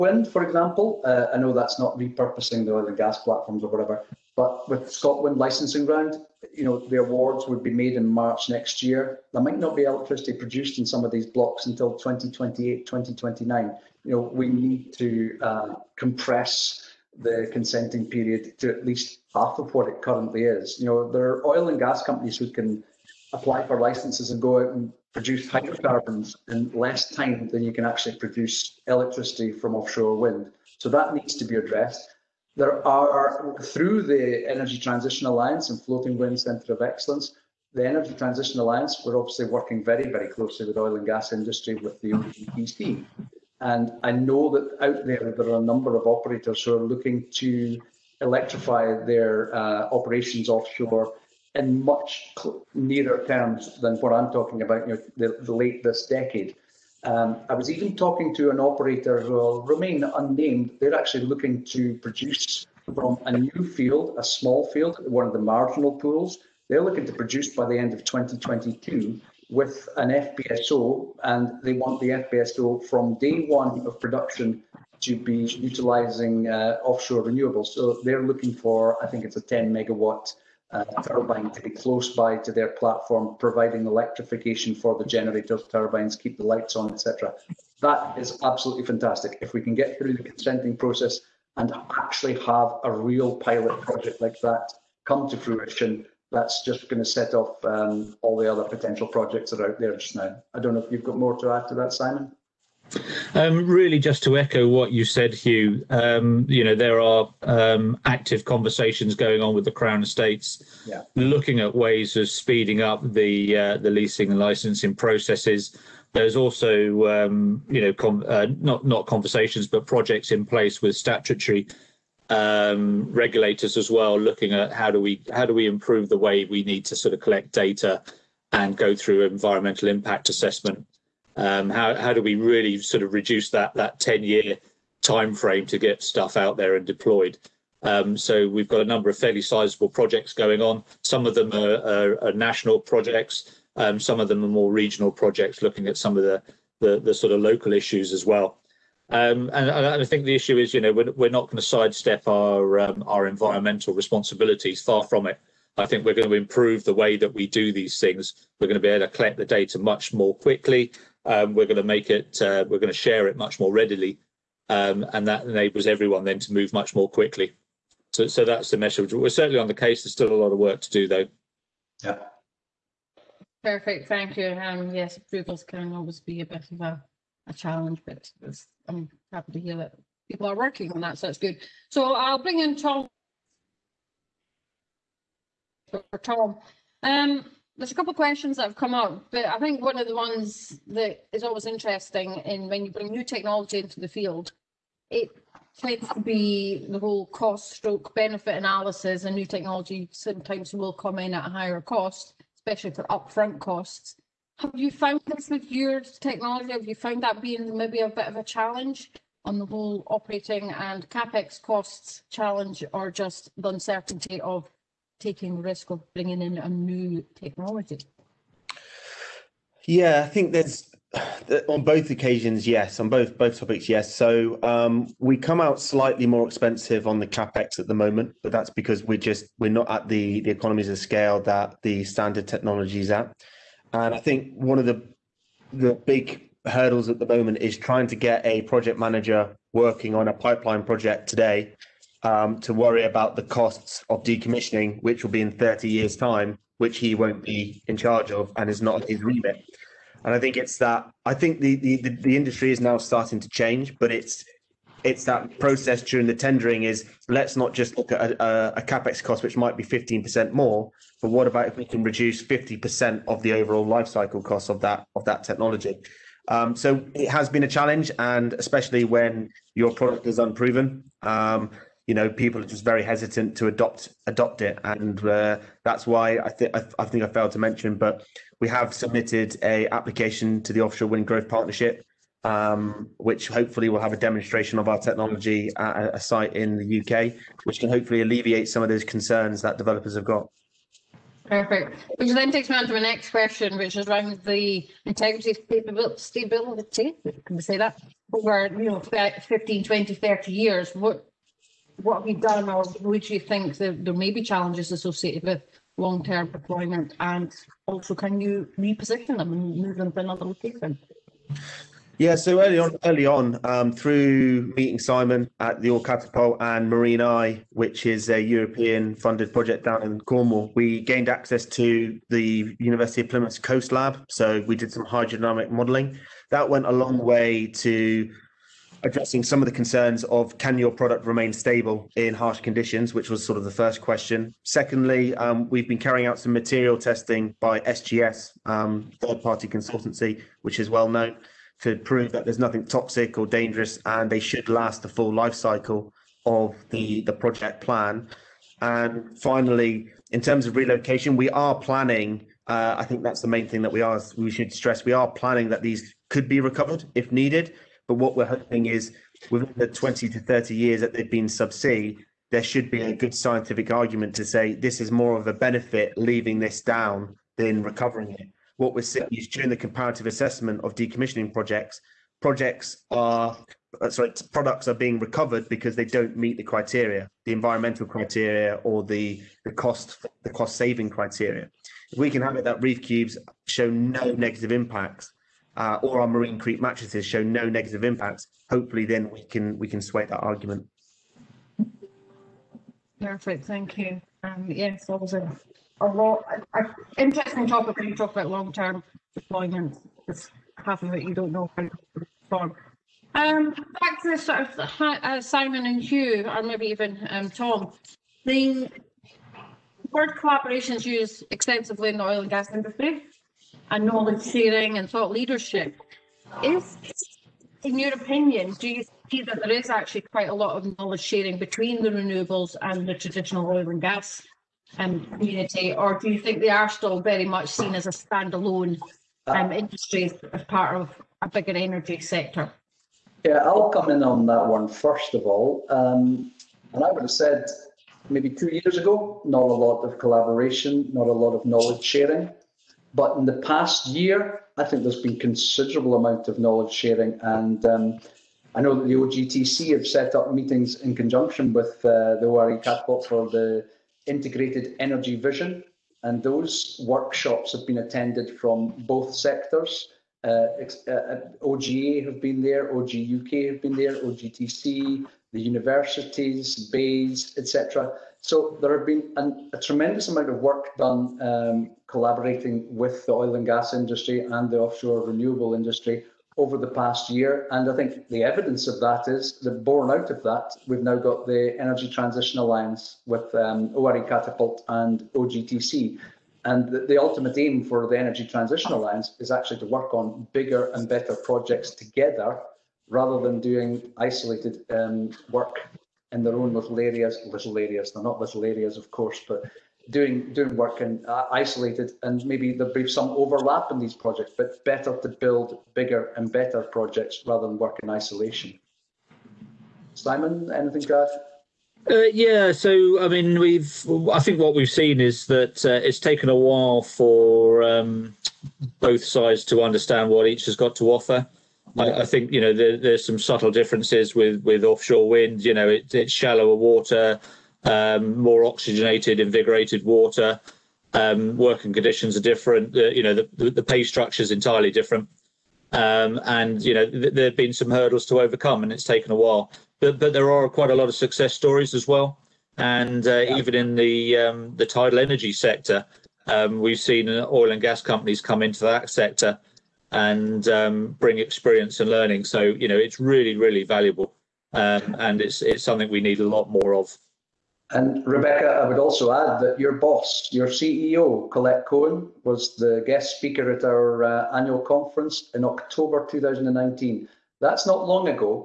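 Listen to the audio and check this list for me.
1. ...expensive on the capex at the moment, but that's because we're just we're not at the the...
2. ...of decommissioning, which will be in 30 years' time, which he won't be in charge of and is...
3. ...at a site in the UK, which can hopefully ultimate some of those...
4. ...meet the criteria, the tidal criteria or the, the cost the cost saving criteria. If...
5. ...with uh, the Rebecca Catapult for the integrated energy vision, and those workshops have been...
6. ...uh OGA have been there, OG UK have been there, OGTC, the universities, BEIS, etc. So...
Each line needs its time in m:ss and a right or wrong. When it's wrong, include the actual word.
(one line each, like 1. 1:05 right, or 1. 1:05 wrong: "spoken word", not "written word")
1. 3:46 right
2. 4:04 right
3. 4:45 wrong: "alleviate", not "ultimate"
4. 6:16 wrong: "environmental", not "tidal"
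5. 7:31 wrong: "ORE", not "Rebecca"
6. 7:41 right.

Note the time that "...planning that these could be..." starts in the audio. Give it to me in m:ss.
5:55.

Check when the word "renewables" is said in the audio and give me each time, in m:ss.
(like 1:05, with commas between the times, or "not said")
1:17, 7:02, 7:55.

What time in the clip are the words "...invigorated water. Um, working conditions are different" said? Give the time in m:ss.
8:49.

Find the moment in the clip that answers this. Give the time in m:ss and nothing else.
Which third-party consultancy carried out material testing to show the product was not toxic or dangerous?
5:37.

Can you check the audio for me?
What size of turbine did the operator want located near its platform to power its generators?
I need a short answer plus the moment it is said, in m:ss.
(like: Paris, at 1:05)
10 megawatt, at 1:19.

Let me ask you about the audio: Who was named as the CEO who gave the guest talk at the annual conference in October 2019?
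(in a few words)
Colette Cohen.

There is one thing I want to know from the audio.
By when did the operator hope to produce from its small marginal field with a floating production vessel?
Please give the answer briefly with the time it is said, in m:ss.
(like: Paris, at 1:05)
end of 2022, at 1:07.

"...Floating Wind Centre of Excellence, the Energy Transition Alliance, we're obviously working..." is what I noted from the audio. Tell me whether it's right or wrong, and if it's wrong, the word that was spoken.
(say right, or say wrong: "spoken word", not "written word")
right.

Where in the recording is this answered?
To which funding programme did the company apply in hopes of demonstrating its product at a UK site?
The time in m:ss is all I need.
4:40.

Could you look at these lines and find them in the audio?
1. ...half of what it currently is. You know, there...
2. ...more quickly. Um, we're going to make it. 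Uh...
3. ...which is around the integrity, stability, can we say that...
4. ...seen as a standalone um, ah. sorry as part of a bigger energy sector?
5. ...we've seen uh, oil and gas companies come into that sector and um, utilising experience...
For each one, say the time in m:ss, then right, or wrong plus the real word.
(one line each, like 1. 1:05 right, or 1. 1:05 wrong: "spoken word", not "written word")
1. 0:19 right
2. 2:40 right
3. 4:53 right
4. 7:07 wrong: "industry", not "sorry"
5. 9:06 wrong: "bring", not "utilising".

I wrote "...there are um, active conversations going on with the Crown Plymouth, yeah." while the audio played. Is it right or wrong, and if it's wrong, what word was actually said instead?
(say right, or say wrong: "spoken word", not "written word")
wrong: "Estates", not "Plymouth".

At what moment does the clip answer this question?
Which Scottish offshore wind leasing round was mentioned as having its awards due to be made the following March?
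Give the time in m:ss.
0:04.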